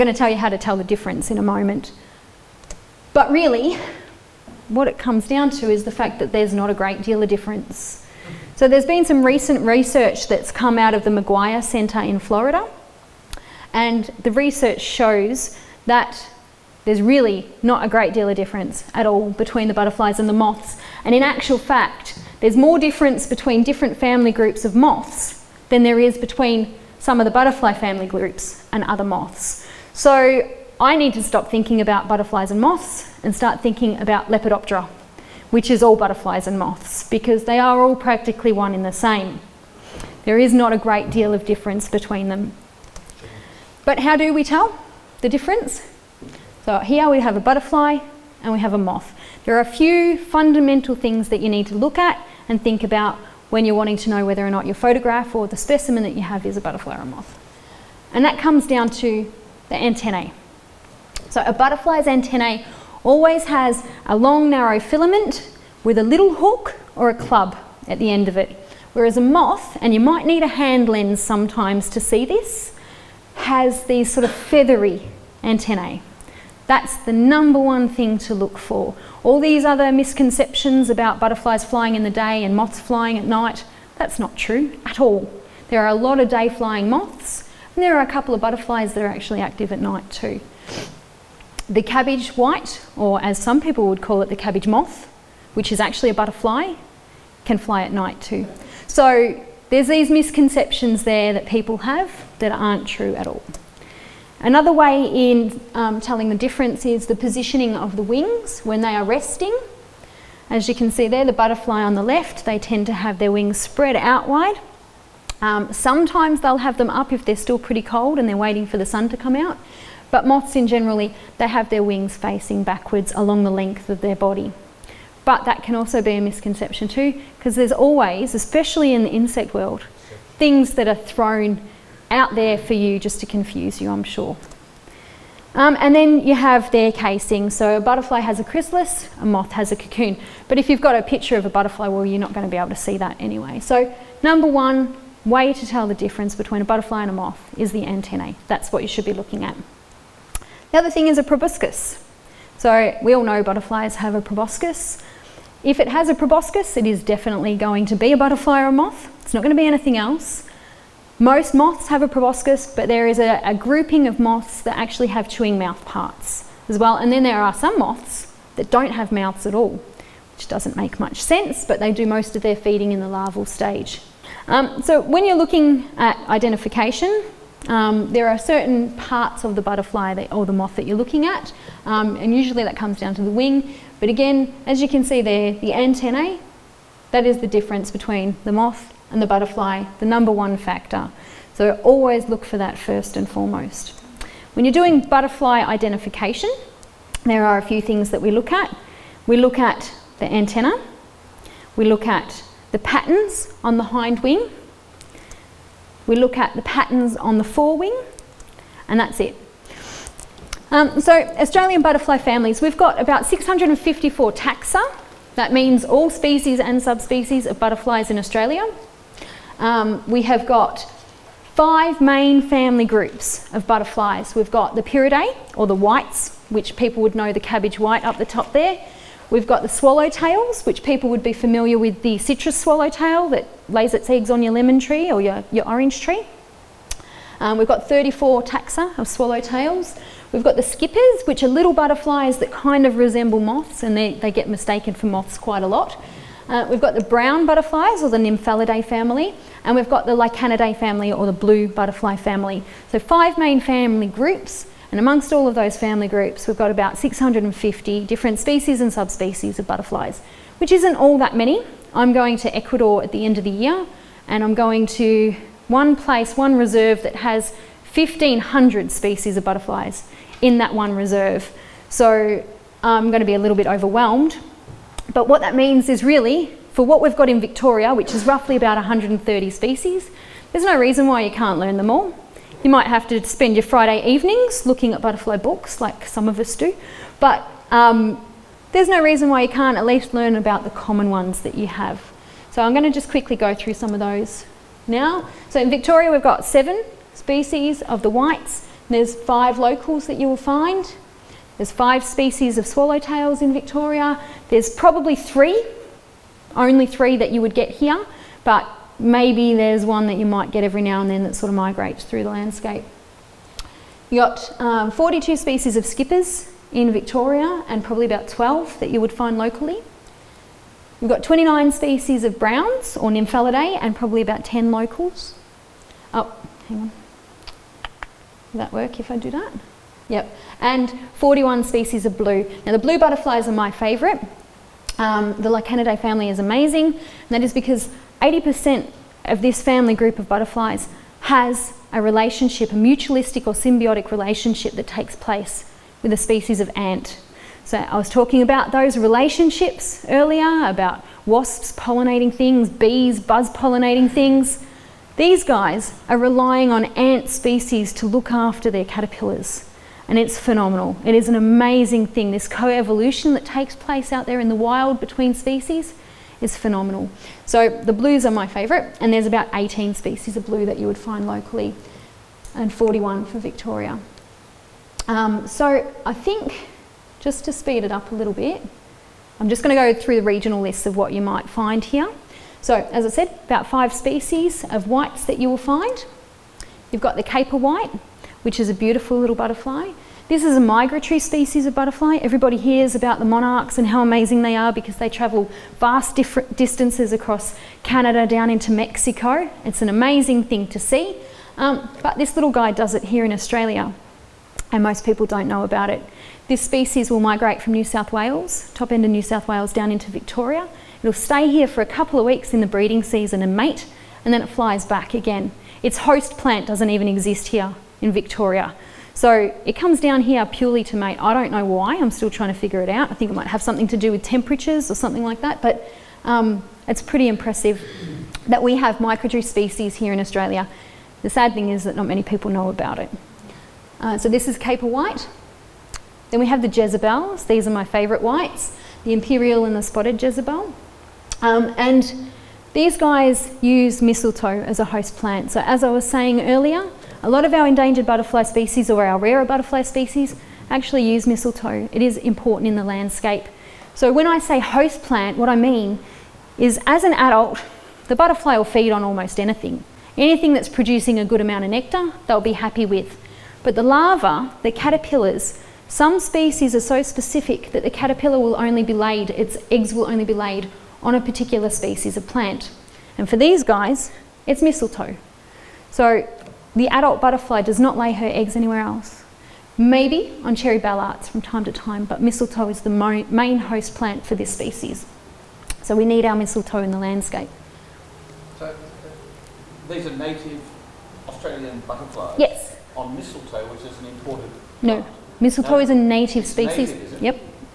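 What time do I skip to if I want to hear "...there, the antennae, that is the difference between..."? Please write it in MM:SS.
03:05.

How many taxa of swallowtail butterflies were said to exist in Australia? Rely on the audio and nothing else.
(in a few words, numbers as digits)
34.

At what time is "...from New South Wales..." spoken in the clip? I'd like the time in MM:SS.
06:47.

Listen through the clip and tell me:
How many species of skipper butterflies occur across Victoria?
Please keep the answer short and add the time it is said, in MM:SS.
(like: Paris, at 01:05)
42, at 05:14.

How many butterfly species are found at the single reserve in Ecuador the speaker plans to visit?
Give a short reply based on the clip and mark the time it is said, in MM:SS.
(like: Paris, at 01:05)
1,500, at 04:27.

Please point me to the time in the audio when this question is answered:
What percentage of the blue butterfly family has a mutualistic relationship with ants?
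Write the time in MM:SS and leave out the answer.
05:38.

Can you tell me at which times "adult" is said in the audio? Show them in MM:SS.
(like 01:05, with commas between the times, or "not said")
07:37, 07:56.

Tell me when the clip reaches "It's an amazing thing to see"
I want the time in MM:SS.
06:39.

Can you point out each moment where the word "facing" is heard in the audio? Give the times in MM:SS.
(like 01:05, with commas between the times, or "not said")
02:02.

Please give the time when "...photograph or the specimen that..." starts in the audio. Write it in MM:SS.
00:54.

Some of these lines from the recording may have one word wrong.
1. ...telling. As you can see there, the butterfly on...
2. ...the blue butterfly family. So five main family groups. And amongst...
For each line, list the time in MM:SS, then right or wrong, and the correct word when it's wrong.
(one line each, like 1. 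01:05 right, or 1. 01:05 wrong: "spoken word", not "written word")
1. 01:49 wrong: "resting", not "telling"
2. 04:11 right.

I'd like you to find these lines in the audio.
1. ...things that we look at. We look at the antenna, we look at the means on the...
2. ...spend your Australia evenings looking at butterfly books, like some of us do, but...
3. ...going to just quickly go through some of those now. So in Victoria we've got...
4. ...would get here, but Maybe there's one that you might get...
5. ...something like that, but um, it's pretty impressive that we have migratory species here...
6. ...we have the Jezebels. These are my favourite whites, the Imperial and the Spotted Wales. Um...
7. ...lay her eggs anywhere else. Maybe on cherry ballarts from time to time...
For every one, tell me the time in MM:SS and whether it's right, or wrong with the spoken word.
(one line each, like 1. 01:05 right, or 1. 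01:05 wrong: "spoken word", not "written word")
1. 03:17 wrong: "patterns", not "means"
2. 04:43 wrong: "Friday", not "Australia"
3. 04:52 right
4. 05:07 right
5. 07:04 right
6. 07:16 wrong: "Jezebel", not "Wales"
7. 07:57 right.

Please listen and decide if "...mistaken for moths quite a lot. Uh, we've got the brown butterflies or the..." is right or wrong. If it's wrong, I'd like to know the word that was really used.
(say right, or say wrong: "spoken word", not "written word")
right.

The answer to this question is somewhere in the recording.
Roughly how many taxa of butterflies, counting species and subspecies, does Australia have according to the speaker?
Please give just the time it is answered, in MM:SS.
03:33.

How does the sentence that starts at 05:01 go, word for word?
There's five species of swallowtails in Victoria.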